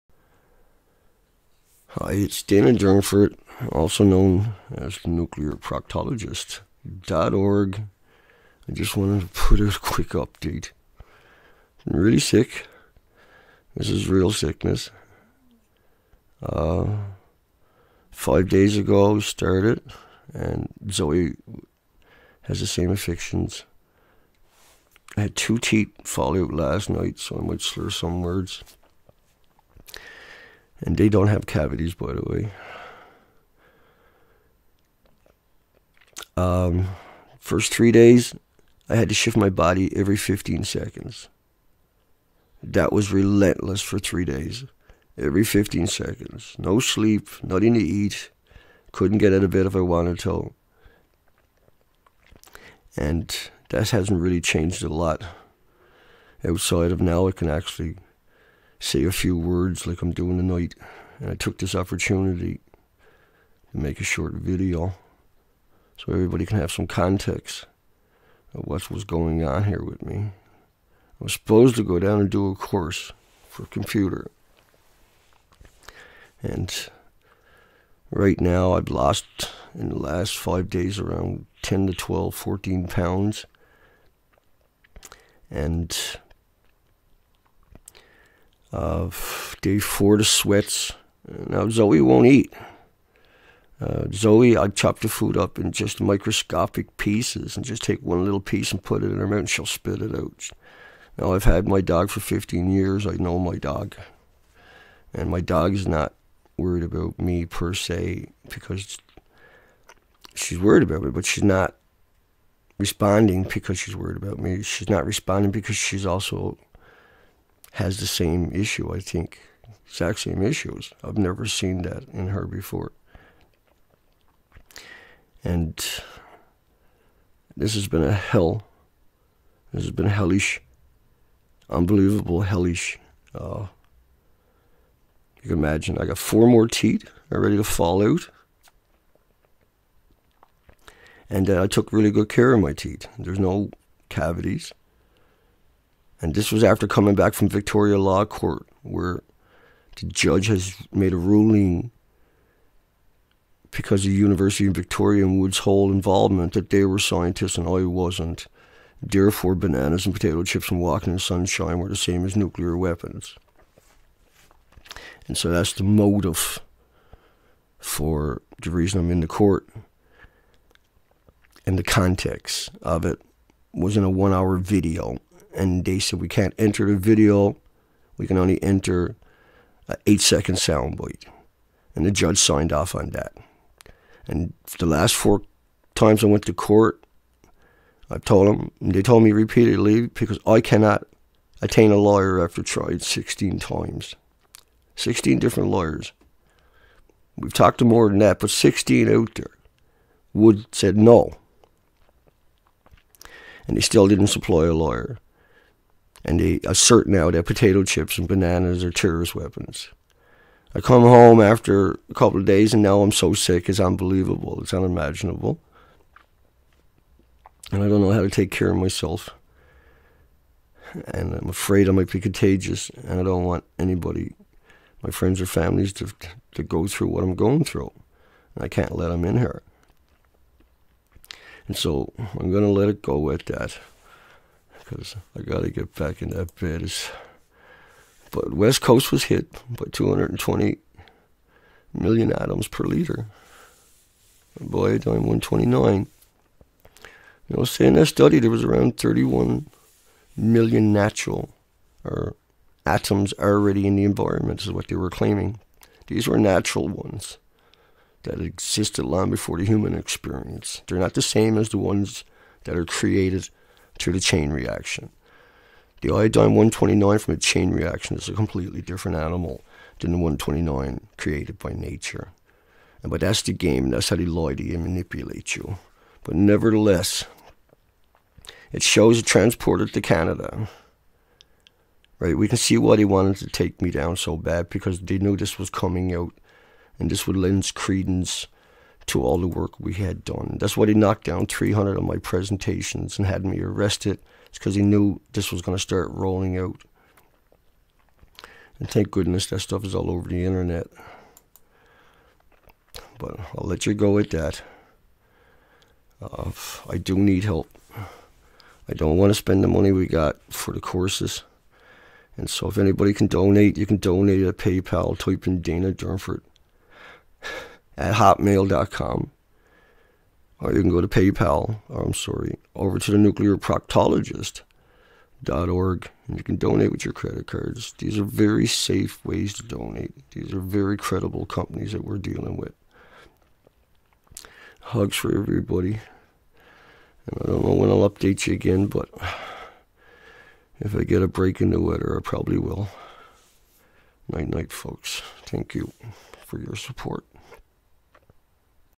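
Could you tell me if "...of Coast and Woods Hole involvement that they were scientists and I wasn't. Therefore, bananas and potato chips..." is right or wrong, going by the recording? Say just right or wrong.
wrong.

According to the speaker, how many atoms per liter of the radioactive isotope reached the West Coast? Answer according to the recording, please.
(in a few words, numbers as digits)
220 million.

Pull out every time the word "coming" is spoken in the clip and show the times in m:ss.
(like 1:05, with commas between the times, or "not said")
2:26, 4:45.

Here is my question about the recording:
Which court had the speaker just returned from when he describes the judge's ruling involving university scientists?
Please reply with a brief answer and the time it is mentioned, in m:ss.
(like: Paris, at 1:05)
Victoria Law Court, at 2:27.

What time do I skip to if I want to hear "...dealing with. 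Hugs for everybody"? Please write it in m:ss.
5:32.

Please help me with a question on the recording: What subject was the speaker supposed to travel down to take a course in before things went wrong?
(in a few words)
computer.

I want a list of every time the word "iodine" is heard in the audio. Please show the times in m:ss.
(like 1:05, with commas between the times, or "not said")
4:04, 4:26.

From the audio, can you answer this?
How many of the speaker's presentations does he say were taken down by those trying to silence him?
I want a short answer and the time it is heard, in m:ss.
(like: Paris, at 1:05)
300, at 4:51.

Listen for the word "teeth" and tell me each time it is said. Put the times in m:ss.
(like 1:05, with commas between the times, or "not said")
0:25, 2:16, 2:22.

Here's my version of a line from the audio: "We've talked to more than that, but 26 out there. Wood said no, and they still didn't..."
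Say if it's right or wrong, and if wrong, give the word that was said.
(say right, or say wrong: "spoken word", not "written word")
wrong: "16", not "26".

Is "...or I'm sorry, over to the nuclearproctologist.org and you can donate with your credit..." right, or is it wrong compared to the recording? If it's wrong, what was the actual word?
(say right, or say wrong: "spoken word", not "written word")
right.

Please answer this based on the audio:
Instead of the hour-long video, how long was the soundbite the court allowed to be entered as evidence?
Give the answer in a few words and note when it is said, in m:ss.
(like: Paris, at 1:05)
8 seconds, at 3:00.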